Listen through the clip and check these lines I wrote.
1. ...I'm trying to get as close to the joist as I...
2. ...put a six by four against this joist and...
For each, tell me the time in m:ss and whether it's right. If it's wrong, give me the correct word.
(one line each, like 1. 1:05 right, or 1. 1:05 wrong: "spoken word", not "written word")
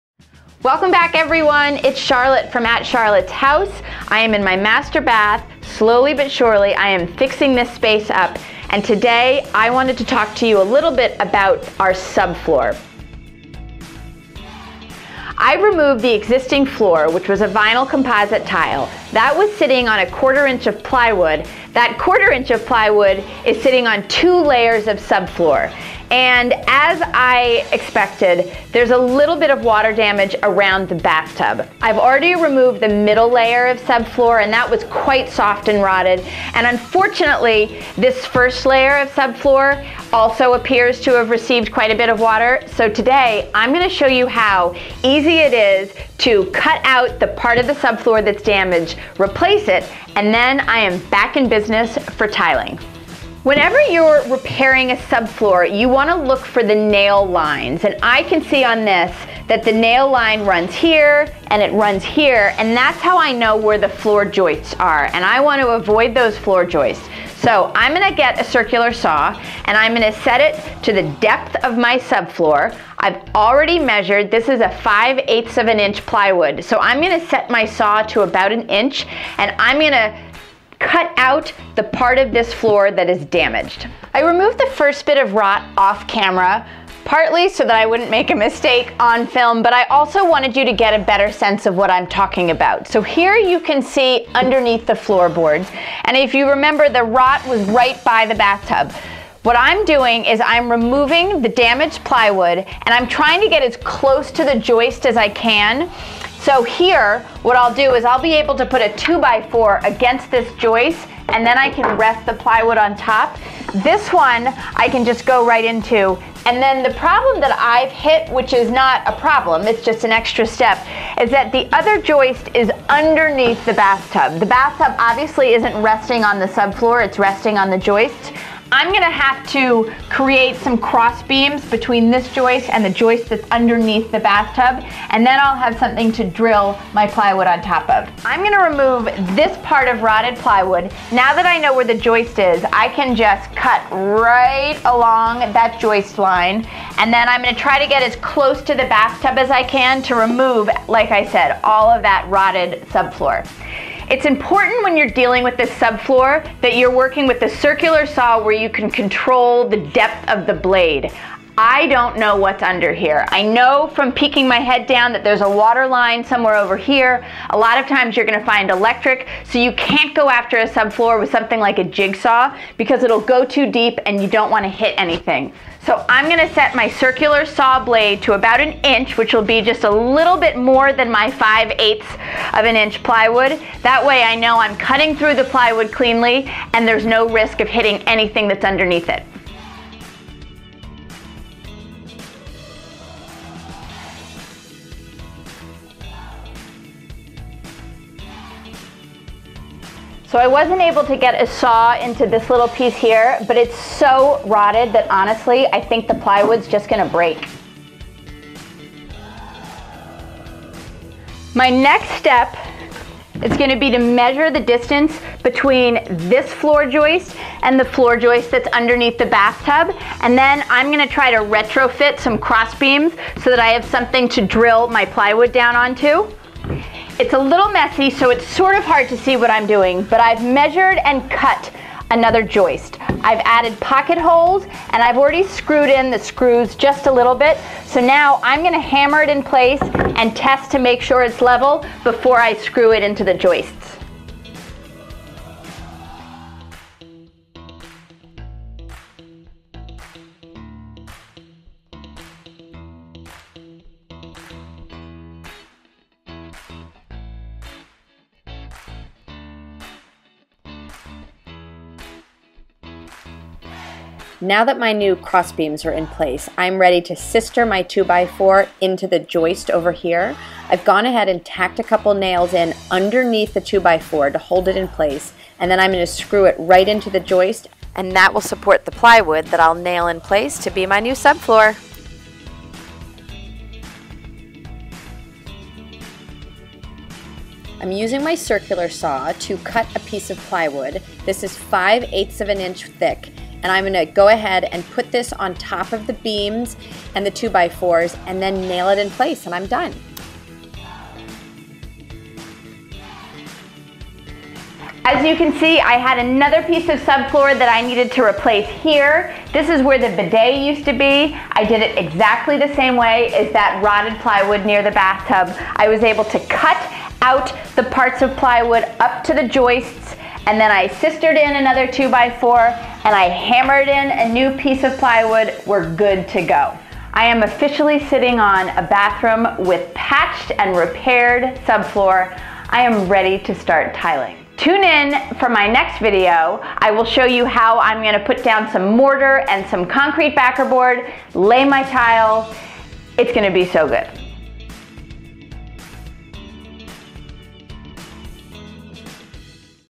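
1. 1:42 right
2. 1:48 wrong: "two", not "six".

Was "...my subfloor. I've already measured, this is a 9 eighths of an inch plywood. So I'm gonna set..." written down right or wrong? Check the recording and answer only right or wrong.
wrong.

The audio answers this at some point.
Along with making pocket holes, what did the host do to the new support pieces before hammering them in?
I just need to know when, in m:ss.
3:55.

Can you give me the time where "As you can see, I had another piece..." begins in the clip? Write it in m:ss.
5:05.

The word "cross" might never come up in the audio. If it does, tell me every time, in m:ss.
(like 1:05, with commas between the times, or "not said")
2:10, 3:42, 4:25.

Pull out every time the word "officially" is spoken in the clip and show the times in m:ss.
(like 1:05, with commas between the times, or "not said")
5:27.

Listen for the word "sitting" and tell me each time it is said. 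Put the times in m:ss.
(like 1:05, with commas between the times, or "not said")
0:19, 0:23, 5:28.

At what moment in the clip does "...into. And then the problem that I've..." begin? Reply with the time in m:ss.
1:55.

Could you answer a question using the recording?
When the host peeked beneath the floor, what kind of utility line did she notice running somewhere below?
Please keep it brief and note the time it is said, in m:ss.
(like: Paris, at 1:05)
water line, at 2:45.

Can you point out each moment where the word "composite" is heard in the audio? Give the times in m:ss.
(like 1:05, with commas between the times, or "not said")
0:17.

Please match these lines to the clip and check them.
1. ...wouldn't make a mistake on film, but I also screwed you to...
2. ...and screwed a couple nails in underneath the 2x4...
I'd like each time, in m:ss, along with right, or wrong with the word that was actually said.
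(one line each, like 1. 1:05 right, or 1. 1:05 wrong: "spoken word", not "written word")
1. 1:27 wrong: "wanted", not "screwed"
2. 4:31 wrong: "tacked", not "screwed".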